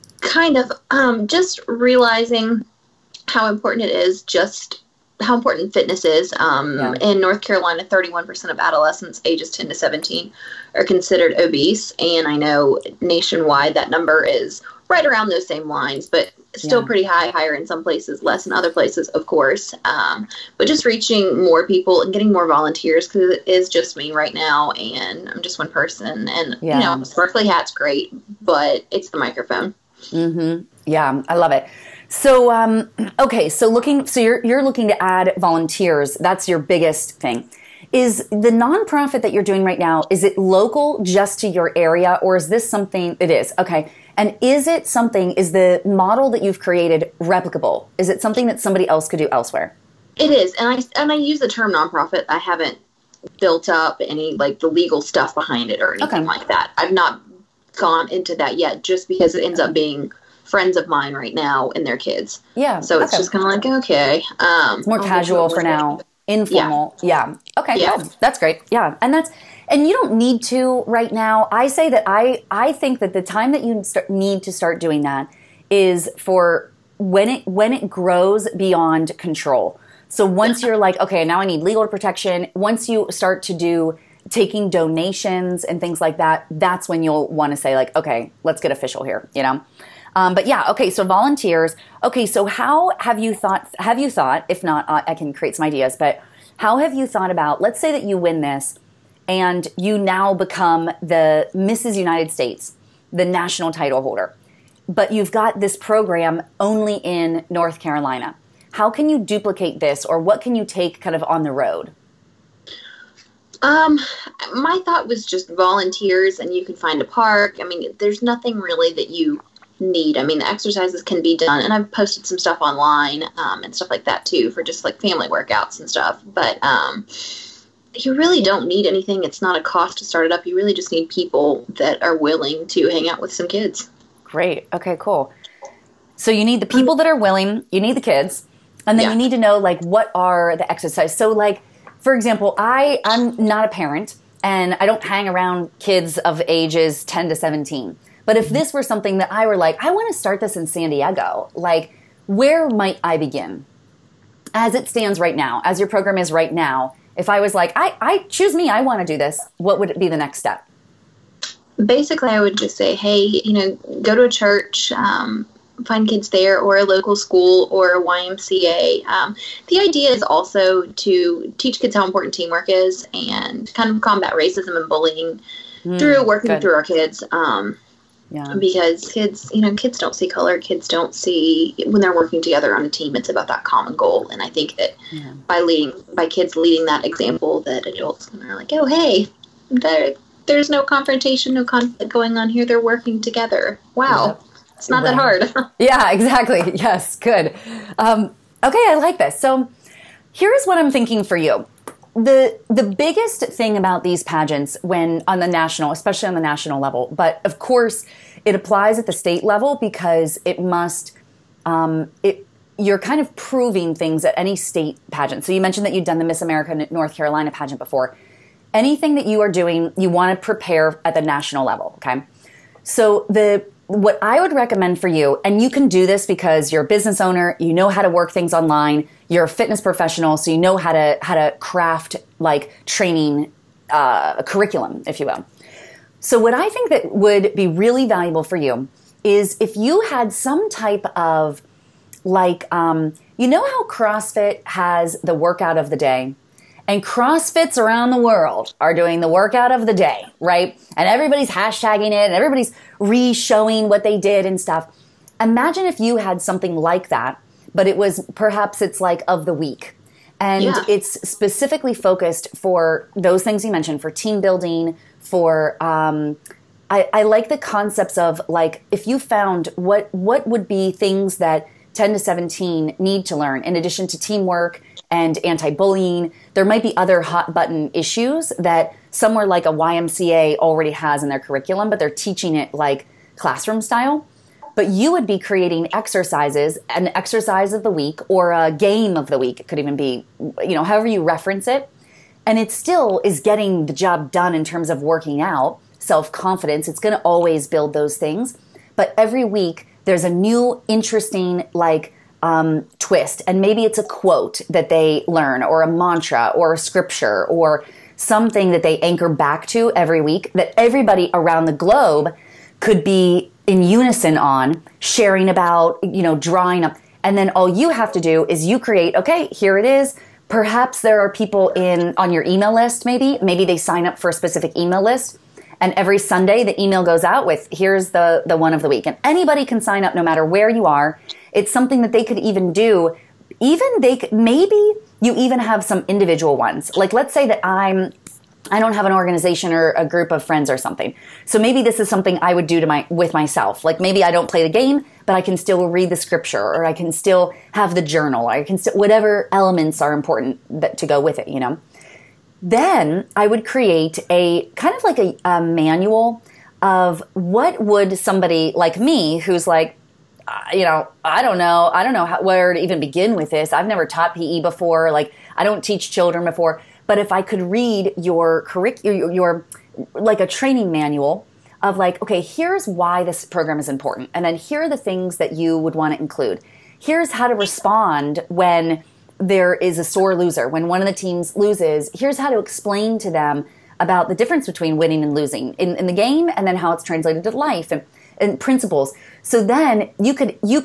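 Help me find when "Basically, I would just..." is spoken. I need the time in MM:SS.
02:41.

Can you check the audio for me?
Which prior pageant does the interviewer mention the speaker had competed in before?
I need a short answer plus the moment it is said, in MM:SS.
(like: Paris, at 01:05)
Miss America North Carolina, at 03:36.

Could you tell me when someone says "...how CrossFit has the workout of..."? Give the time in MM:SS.
04:03.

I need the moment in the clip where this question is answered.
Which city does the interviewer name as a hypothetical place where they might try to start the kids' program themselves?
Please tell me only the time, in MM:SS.
02:30.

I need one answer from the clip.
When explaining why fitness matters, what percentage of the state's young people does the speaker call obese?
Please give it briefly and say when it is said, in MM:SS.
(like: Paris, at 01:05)
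31%, at 00:07.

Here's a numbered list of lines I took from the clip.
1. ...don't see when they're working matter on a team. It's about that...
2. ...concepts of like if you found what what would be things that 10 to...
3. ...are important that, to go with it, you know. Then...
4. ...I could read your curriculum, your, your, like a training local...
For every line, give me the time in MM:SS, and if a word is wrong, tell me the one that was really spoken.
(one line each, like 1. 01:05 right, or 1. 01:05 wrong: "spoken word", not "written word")
1. 03:00 wrong: "together", not "matter"
2. 04:27 right
3. 05:50 right
4. 06:07 wrong: "manual", not "local".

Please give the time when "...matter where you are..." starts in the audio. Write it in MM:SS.
05:30.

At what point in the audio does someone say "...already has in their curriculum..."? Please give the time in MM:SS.
04:40.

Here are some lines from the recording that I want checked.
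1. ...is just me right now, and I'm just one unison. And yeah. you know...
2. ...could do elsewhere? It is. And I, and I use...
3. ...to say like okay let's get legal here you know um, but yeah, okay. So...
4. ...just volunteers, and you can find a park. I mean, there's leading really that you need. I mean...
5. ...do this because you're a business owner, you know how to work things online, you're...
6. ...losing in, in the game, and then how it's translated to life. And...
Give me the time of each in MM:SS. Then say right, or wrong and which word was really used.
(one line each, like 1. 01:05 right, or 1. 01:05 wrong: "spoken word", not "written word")
1. 00:23 wrong: "person", not "unison"
2. 00:49 right
3. 01:27 wrong: "official", not "legal"
4. 01:55 wrong: "nothing", not "leading"
5. 03:45 right
6. 06:25 right.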